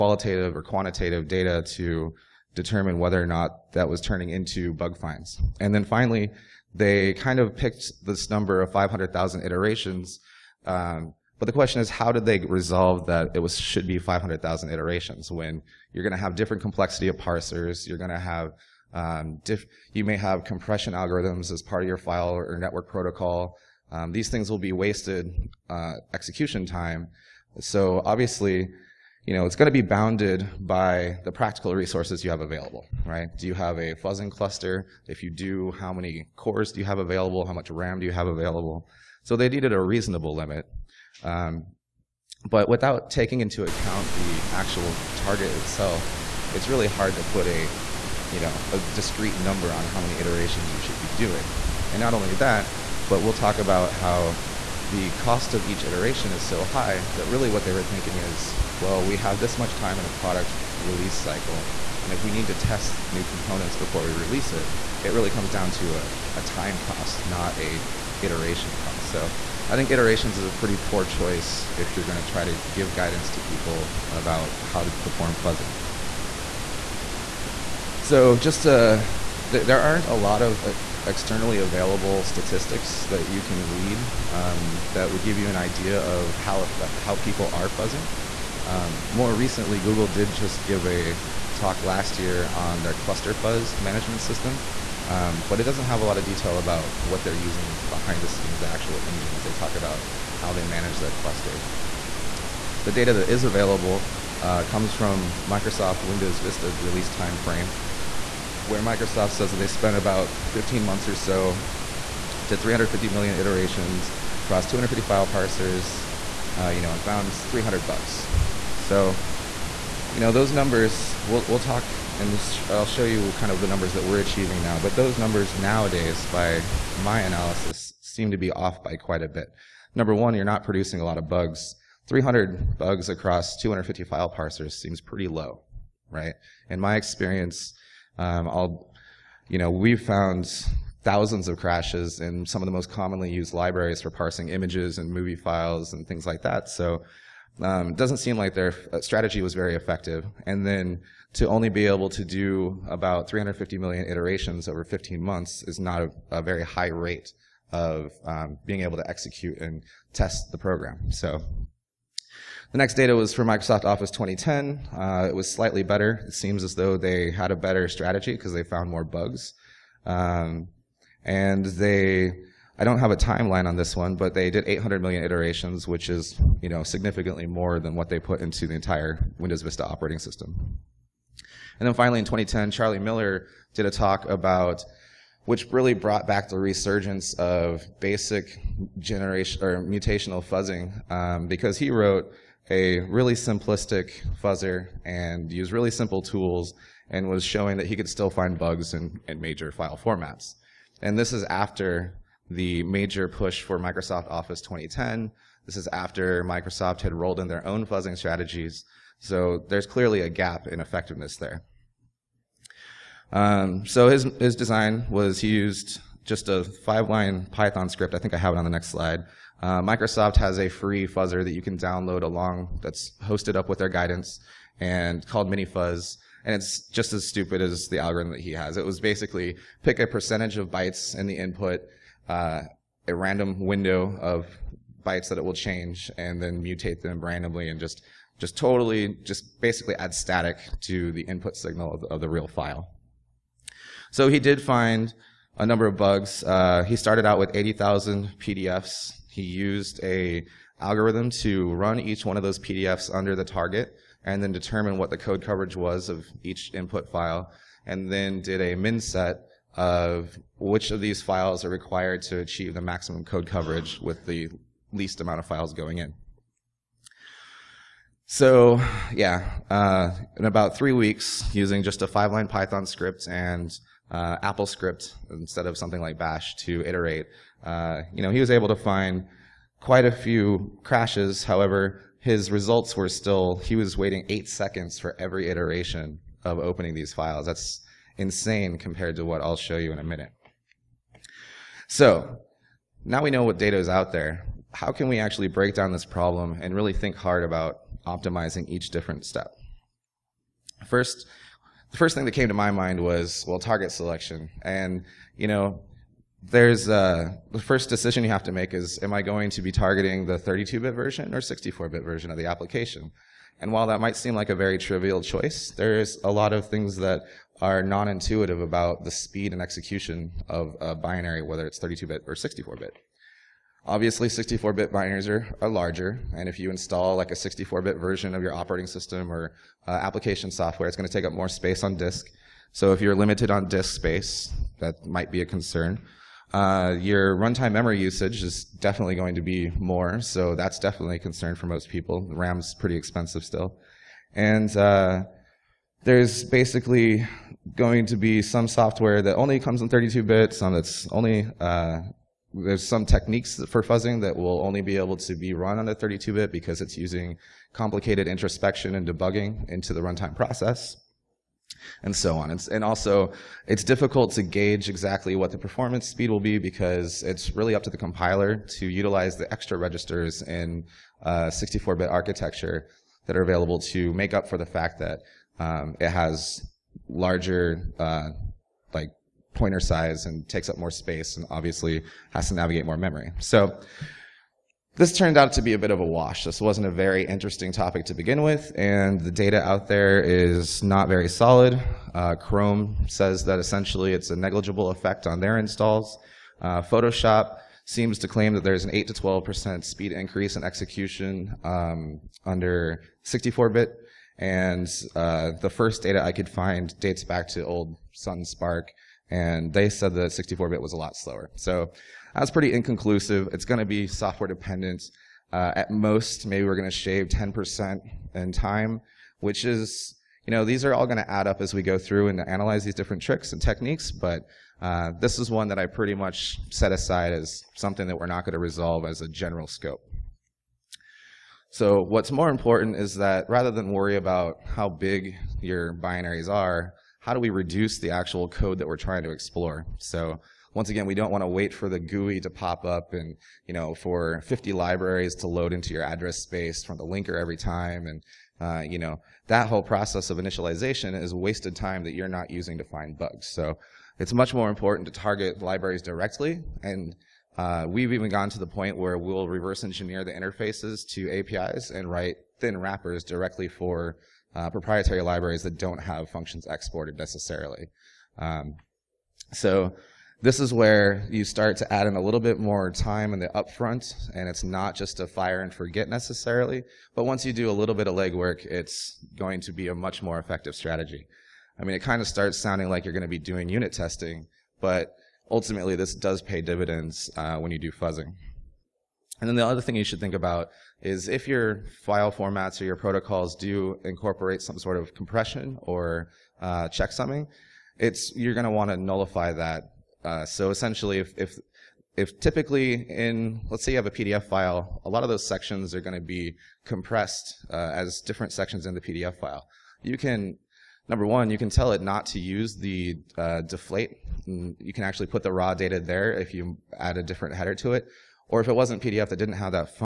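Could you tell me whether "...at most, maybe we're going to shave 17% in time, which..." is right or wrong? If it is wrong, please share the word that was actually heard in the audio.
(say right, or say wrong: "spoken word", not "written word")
wrong: "10", not "17".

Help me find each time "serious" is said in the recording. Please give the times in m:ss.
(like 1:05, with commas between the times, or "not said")
not said.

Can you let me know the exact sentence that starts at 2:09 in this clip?
Number one, you're not producing a lot of bugs.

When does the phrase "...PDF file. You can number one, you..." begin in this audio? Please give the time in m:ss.
8:29.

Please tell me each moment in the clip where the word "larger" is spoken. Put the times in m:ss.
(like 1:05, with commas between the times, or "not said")
5:25, 6:17.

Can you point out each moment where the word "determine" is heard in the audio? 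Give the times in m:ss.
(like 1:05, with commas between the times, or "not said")
0:02, 4:14.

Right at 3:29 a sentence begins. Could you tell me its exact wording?
So there's clearly a gap in effectiveness there.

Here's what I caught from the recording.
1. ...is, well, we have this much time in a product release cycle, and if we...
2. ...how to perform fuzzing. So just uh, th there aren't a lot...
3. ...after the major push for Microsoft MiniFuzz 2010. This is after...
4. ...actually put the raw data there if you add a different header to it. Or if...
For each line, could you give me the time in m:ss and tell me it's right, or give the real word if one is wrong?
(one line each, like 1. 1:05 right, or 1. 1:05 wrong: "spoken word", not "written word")
1. 0:58 right
2. 1:14 right
3. 3:21 wrong: "Office", not "MiniFuzz"
4. 8:35 right.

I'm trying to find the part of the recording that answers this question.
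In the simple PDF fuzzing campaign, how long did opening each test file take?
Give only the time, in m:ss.
4:44.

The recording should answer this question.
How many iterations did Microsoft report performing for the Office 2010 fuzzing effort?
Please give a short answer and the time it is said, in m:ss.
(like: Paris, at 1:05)
800 million, at 2:54.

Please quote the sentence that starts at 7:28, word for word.
And, uh, you know, that whole process of initialization is wasted time that you're not using to find bugs.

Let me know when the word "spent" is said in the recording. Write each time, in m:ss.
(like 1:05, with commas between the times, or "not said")
1:49.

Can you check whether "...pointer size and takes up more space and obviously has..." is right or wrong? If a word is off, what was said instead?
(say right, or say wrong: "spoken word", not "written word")
right.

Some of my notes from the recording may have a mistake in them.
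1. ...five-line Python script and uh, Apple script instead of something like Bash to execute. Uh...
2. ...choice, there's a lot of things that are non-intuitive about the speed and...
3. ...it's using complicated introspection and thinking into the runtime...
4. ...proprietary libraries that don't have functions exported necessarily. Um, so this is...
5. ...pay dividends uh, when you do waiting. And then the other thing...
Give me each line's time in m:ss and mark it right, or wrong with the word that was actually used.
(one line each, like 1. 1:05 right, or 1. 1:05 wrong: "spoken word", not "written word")
1. 4:32 wrong: "iterate", not "execute"
2. 5:15 right
3. 5:56 wrong: "debugging", not "thinking"
4. 7:44 right
5. 8:06 wrong: "fuzzing", not "waiting".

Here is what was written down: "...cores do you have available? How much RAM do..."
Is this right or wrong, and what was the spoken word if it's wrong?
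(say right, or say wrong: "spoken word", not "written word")
right.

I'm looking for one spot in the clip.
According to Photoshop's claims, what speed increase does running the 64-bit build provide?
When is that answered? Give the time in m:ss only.
6:38.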